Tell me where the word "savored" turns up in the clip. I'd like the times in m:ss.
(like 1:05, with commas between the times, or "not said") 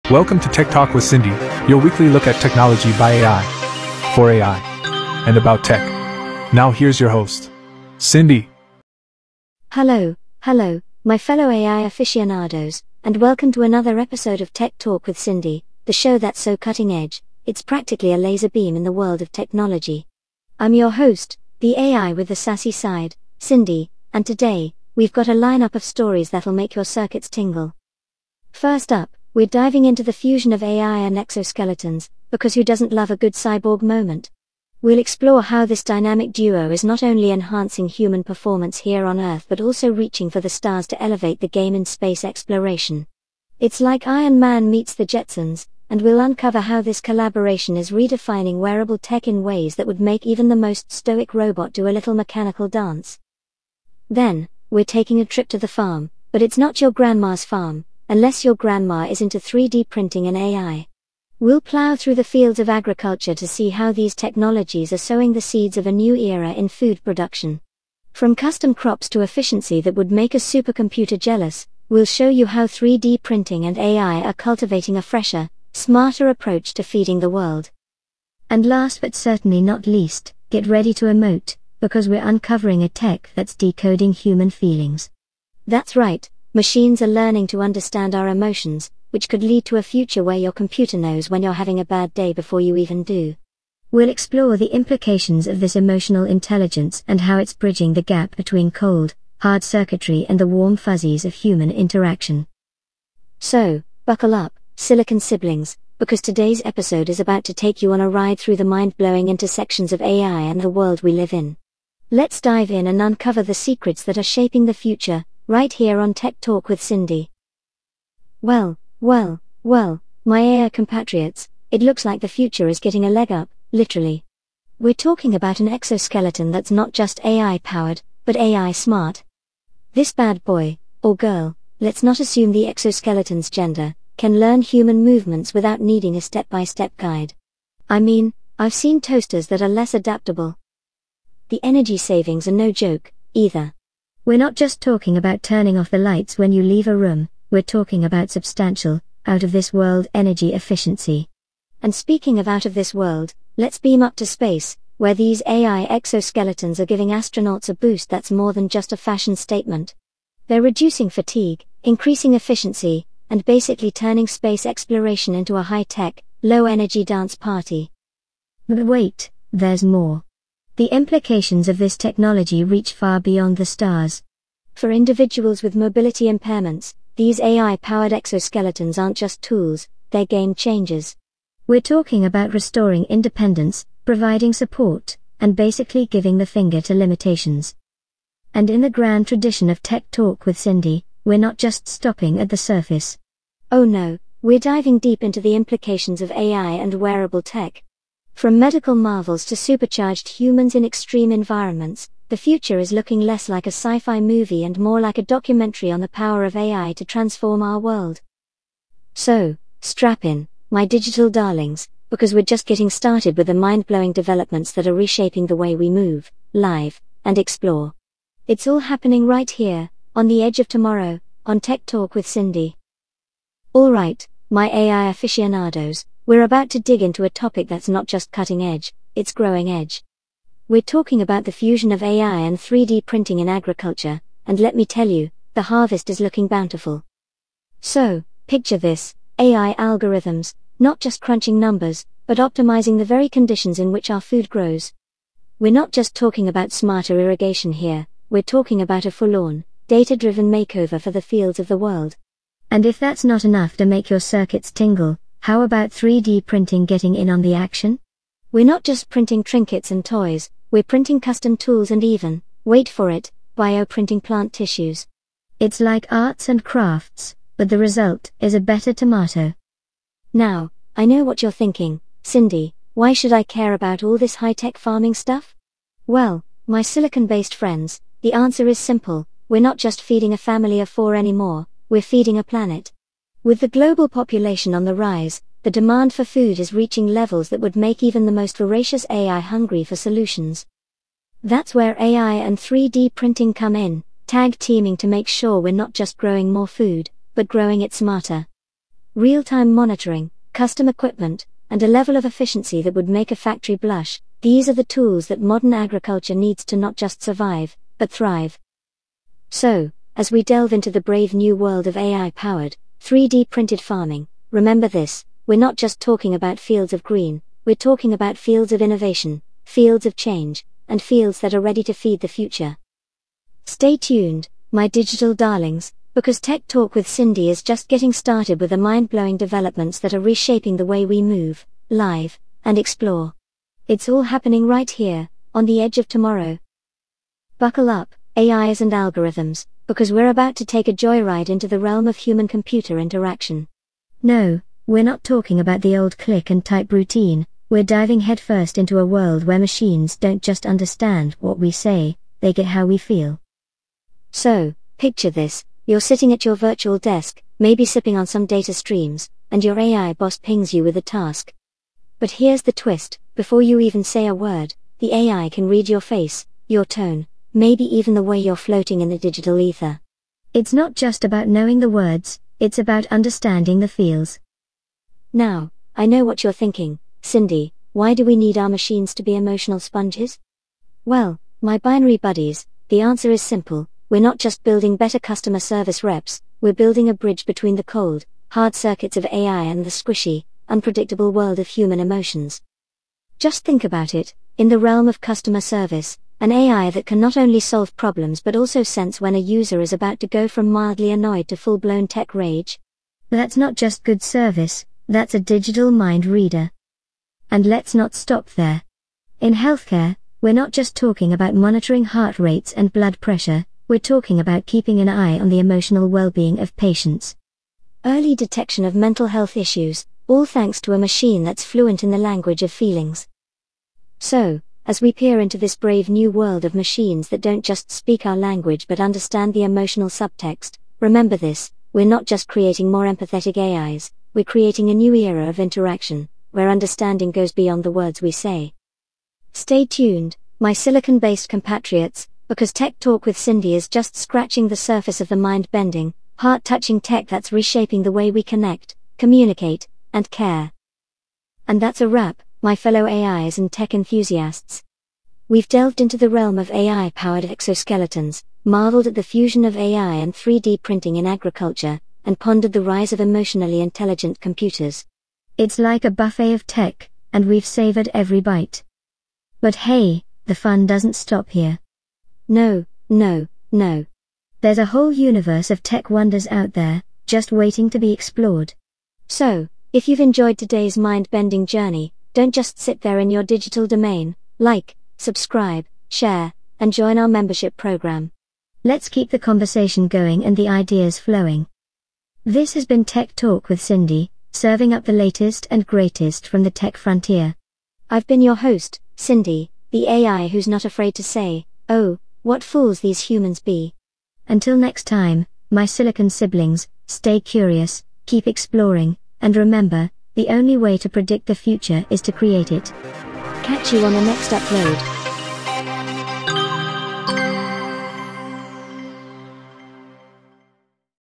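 7:47.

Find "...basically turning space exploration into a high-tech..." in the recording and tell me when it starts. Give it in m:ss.
2:43.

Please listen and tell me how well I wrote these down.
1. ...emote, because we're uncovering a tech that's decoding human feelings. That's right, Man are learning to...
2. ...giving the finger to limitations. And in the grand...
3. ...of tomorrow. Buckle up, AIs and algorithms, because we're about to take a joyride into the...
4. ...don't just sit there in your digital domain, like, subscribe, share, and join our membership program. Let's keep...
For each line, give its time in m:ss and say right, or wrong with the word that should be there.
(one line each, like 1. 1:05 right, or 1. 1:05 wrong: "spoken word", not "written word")
1. 1:21 wrong: "Machines", not "Man"
2. 3:06 right
3. 5:35 right
4. 8:02 right.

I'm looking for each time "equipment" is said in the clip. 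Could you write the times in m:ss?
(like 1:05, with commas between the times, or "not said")
5:00.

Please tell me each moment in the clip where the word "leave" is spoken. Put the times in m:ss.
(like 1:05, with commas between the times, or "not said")
2:26.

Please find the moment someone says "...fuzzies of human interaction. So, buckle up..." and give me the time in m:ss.
1:40.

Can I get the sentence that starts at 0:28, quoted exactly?
First up, we're diving into the fusion of AI and exoskeletons, because who doesn't love a good cyborg moment?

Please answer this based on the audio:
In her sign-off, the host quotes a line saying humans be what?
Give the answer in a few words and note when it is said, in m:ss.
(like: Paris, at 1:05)
fools, at 8:22.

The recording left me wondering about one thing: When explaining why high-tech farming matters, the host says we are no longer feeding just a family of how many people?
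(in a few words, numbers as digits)
4.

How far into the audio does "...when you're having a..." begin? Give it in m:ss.
1:31.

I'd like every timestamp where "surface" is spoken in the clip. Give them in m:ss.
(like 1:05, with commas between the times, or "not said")
3:12, 7:24.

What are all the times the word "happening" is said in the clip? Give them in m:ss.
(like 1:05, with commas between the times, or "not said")
3:38, 5:34.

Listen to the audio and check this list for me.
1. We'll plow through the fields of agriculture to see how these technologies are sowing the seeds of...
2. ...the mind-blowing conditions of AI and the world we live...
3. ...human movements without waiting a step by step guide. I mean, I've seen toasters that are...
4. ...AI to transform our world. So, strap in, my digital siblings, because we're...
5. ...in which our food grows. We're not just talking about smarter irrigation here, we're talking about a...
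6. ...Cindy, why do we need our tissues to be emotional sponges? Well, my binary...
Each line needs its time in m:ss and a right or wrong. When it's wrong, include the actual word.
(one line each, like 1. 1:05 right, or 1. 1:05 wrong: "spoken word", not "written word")
1. 1:01 right
2. 1:48 wrong: "intersections", not "conditions"
3. 2:14 wrong: "needing", not "waiting"
4. 3:26 wrong: "darlings", not "siblings"
5. 4:03 right
6. 6:17 wrong: "machines", not "tissues".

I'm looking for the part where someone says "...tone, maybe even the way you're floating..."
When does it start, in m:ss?
6:06.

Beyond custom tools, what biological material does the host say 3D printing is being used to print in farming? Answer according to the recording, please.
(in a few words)
plant tissues.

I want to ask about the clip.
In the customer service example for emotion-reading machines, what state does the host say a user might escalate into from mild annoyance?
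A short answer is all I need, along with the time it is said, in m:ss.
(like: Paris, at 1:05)
tech rage, at 6:42.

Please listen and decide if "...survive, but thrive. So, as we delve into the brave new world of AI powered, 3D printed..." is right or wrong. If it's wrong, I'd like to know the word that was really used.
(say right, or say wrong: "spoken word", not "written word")
right.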